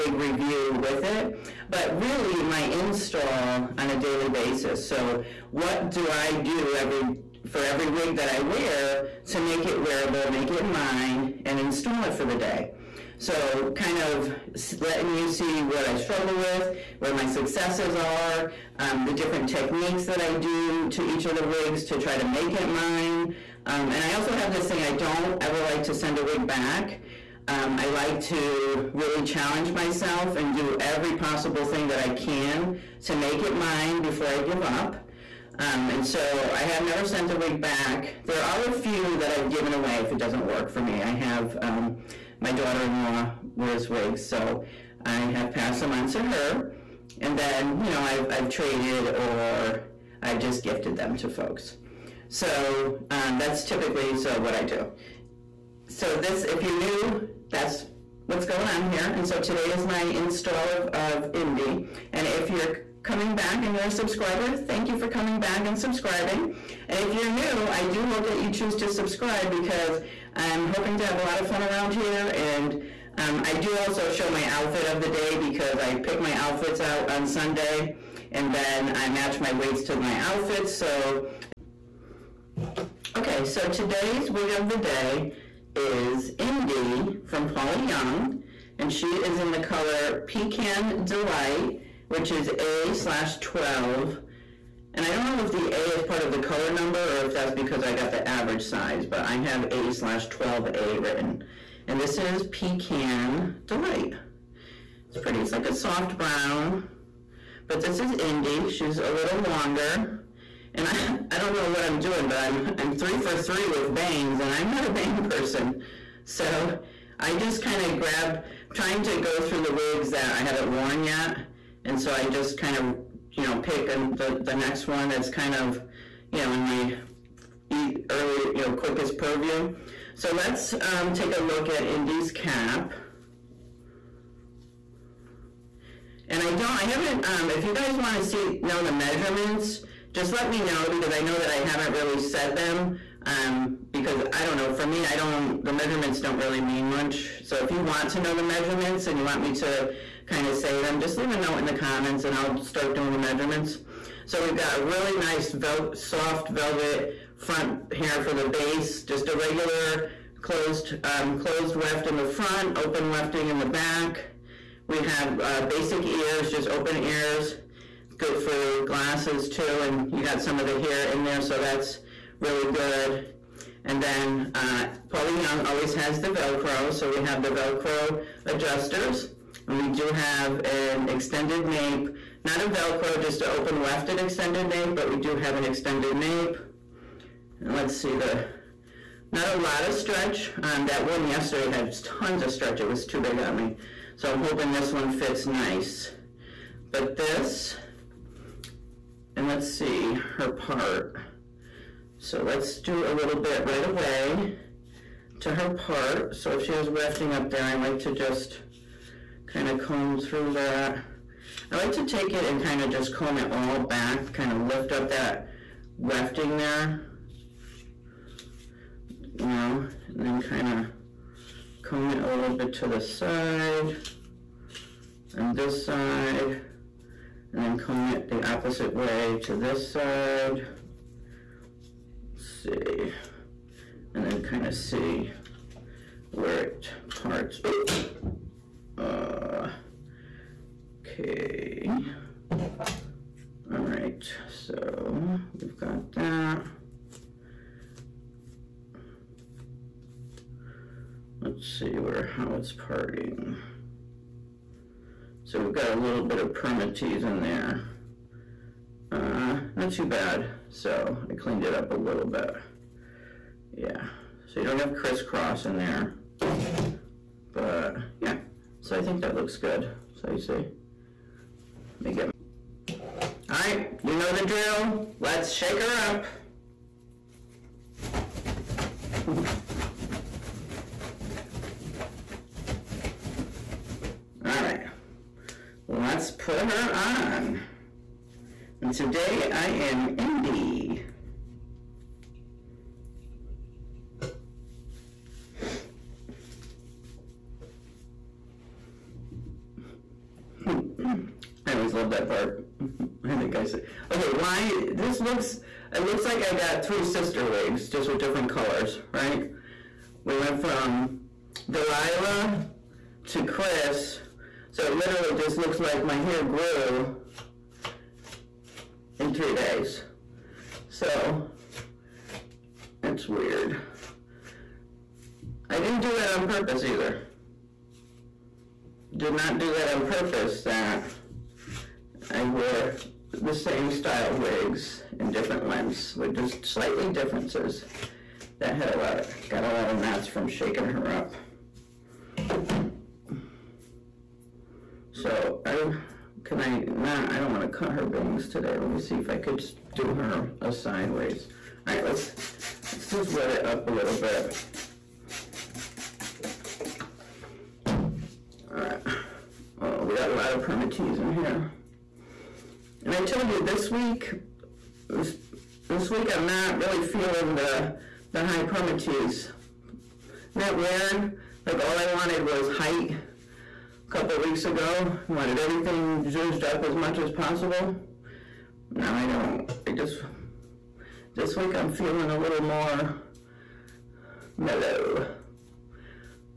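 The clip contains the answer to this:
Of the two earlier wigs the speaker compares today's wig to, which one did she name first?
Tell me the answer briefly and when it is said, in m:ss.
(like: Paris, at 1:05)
Delilah, at 5:11.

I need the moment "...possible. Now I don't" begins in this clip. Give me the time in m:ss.
6:17.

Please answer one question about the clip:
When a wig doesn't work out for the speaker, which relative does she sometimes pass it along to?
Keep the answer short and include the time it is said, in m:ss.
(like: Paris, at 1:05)
Daughter-in-law, at 0:42.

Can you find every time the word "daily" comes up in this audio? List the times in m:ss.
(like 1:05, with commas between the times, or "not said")
0:03.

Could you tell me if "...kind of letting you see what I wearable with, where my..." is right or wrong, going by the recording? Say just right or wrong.
wrong.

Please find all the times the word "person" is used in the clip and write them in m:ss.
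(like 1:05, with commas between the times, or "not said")
1:55.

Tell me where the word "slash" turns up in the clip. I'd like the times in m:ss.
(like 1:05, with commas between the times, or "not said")
1:32, 1:39.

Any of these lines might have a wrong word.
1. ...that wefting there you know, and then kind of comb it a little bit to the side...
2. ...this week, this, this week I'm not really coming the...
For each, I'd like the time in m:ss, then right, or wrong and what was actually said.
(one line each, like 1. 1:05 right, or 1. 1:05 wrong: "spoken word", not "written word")
1. 3:35 right
2. 6:03 wrong: "feeling", not "coming".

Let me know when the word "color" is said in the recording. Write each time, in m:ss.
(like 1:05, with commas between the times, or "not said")
1:29, 1:36, 5:08.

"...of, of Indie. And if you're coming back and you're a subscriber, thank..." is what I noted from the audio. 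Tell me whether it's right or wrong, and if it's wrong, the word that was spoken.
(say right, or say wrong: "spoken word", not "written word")
right.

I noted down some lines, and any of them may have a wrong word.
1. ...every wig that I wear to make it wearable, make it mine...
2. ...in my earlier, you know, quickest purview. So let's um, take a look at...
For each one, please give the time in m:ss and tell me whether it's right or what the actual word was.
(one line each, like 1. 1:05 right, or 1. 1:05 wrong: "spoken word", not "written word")
1. 0:07 right
2. 2:06 right.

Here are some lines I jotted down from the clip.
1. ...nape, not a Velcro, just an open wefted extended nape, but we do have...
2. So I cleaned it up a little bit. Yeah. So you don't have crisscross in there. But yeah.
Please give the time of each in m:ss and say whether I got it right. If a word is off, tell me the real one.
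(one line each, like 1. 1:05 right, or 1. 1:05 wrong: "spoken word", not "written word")
1. 3:01 right
2. 4:20 right.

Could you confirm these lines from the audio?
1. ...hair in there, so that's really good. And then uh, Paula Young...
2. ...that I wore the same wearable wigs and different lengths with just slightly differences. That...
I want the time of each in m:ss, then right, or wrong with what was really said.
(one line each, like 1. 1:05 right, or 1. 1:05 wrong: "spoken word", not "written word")
1. 2:50 right
2. 5:30 wrong: "style", not "wearable".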